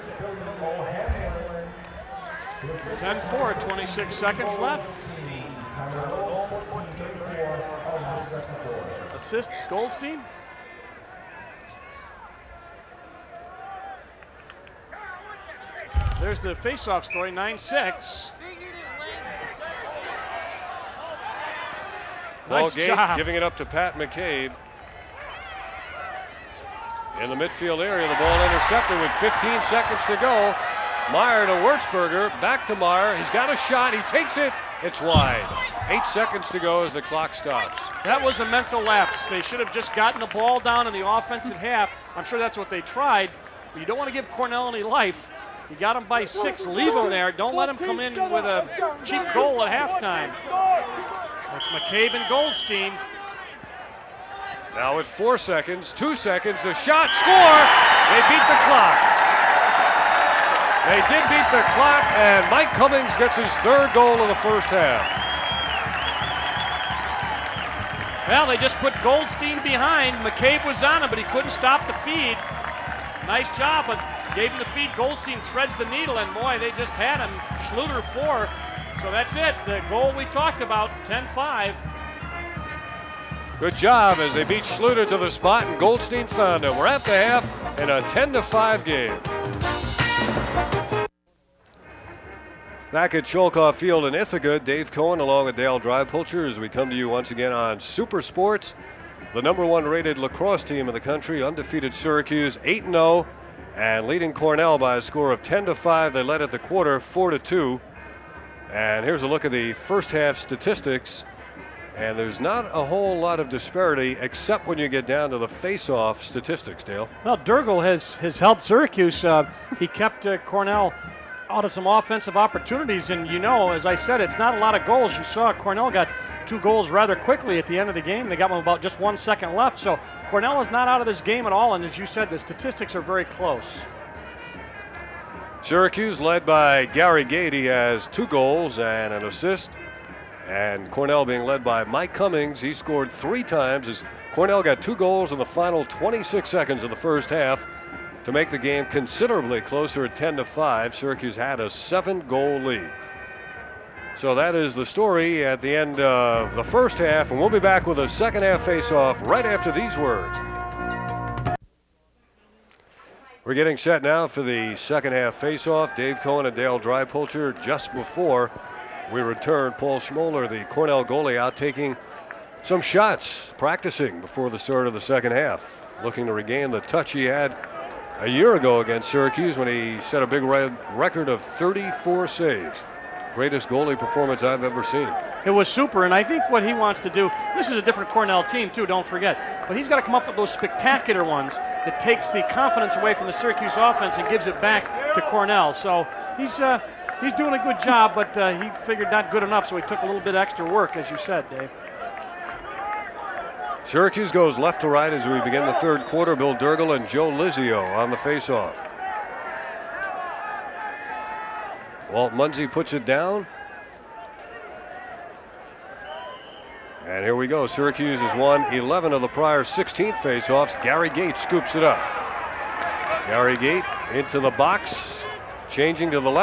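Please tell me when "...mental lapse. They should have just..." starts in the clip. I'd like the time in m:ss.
0:38.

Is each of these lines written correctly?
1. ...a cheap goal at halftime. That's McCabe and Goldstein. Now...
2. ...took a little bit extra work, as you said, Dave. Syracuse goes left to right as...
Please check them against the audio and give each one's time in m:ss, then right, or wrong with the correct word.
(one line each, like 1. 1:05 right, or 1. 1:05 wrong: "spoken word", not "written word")
1. 0:48 right
2. 3:19 right.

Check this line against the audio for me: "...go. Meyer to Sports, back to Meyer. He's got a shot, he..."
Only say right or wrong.
wrong.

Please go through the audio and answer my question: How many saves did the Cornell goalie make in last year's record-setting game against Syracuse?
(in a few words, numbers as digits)
34.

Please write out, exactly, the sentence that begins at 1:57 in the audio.
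Well, Dirrigl has, has helped Syracuse.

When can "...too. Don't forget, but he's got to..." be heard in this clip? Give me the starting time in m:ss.
3:08.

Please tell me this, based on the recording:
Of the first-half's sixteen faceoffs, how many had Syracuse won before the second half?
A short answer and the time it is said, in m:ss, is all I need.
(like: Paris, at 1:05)
11, at 3:38.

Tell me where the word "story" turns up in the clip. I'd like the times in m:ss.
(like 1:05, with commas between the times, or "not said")
0:17, 2:34.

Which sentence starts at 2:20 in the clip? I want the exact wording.
And Cornell being led by Mike Cummings.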